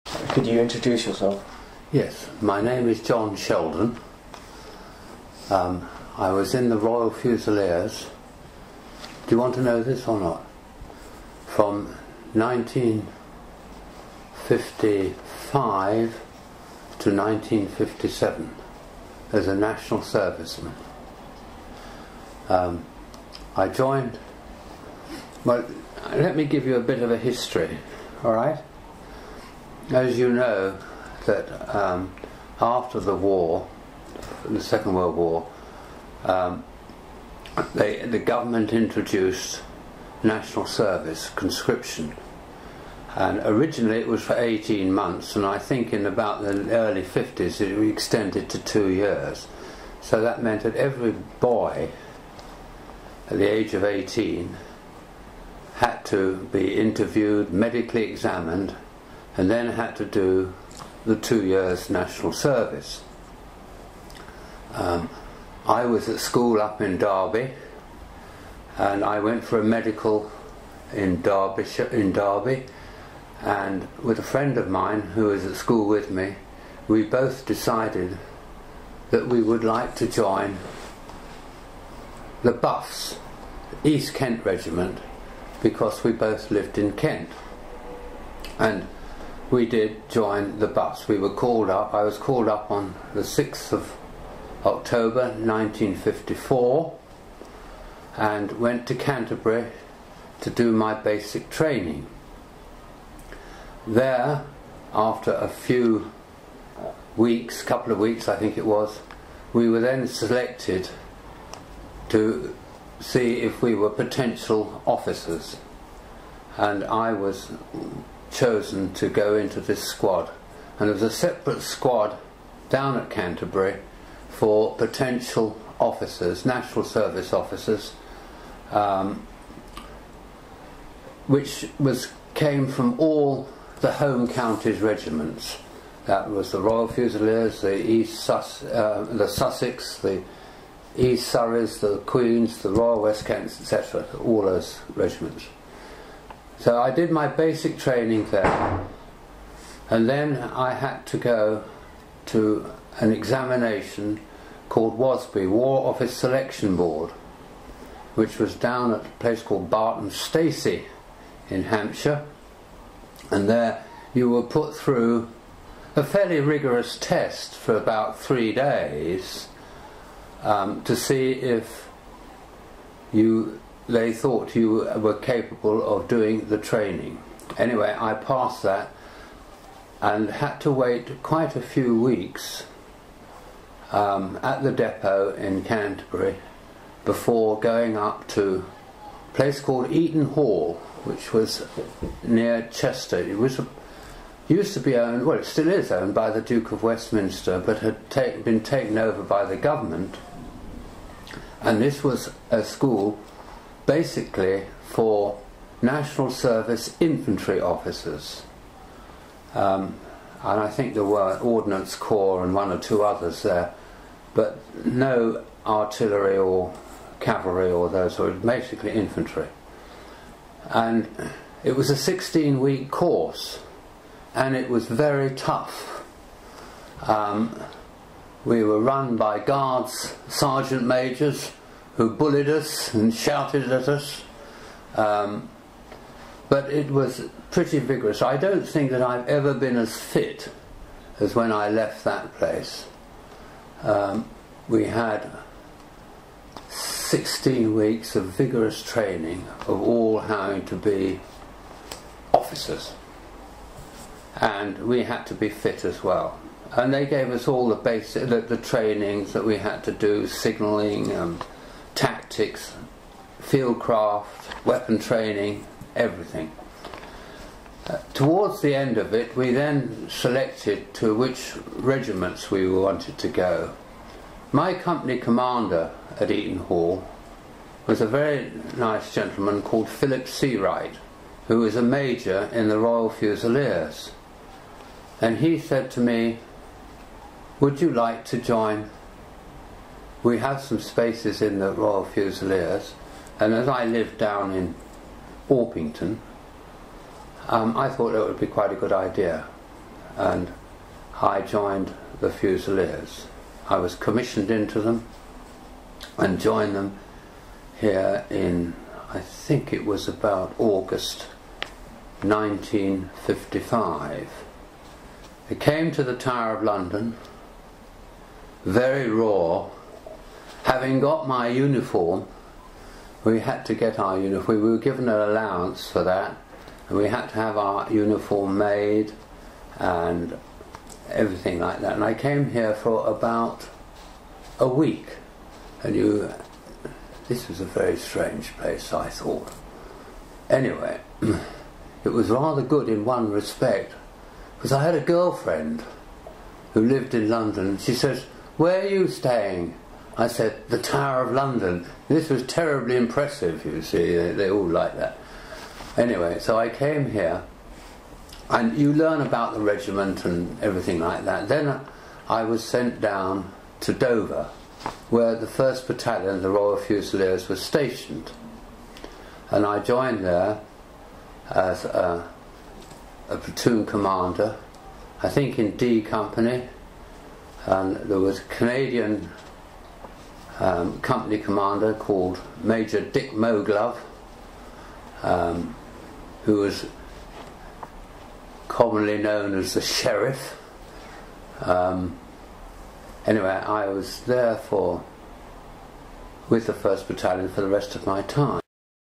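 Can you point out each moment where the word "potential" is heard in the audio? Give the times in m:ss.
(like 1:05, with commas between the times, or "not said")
1:53, 2:04.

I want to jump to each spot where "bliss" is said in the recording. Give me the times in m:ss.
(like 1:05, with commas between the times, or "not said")
not said.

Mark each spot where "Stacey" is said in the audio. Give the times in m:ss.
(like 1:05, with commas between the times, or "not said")
2:40.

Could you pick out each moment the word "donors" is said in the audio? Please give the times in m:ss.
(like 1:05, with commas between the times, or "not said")
not said.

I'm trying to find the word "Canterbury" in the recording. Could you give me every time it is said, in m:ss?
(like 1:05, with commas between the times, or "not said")
1:38, 2:03, 3:05.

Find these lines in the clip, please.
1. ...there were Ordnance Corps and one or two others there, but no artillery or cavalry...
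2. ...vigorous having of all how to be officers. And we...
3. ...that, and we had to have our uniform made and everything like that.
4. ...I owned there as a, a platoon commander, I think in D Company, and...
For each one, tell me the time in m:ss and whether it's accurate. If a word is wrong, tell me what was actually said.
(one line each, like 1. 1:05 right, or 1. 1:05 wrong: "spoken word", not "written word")
1. 3:30 right
2. 4:08 wrong: "training", not "having"
3. 5:26 right
4. 6:09 wrong: "joined", not "owned".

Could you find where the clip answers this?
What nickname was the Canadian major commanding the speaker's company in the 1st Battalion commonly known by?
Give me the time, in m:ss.
6:29.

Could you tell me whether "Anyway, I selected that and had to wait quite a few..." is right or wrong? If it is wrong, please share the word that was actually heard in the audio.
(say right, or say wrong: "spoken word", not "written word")
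wrong: "passed", not "selected".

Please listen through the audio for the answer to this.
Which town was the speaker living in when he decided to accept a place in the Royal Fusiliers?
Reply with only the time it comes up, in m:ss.
4:55.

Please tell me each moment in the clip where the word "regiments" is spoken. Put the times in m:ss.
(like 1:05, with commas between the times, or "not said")
1:24, 2:14, 2:24, 4:31, 5:59.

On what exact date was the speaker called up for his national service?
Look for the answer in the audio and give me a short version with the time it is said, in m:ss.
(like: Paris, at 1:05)
6 October 1954, at 1:33.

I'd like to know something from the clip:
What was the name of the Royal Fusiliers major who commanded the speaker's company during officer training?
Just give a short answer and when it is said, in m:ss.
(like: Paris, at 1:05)
Philip Seawright, at 4:39.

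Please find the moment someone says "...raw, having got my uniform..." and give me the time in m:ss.
5:19.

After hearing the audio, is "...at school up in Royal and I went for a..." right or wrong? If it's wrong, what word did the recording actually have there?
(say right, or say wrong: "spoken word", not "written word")
wrong: "Derby", not "Royal".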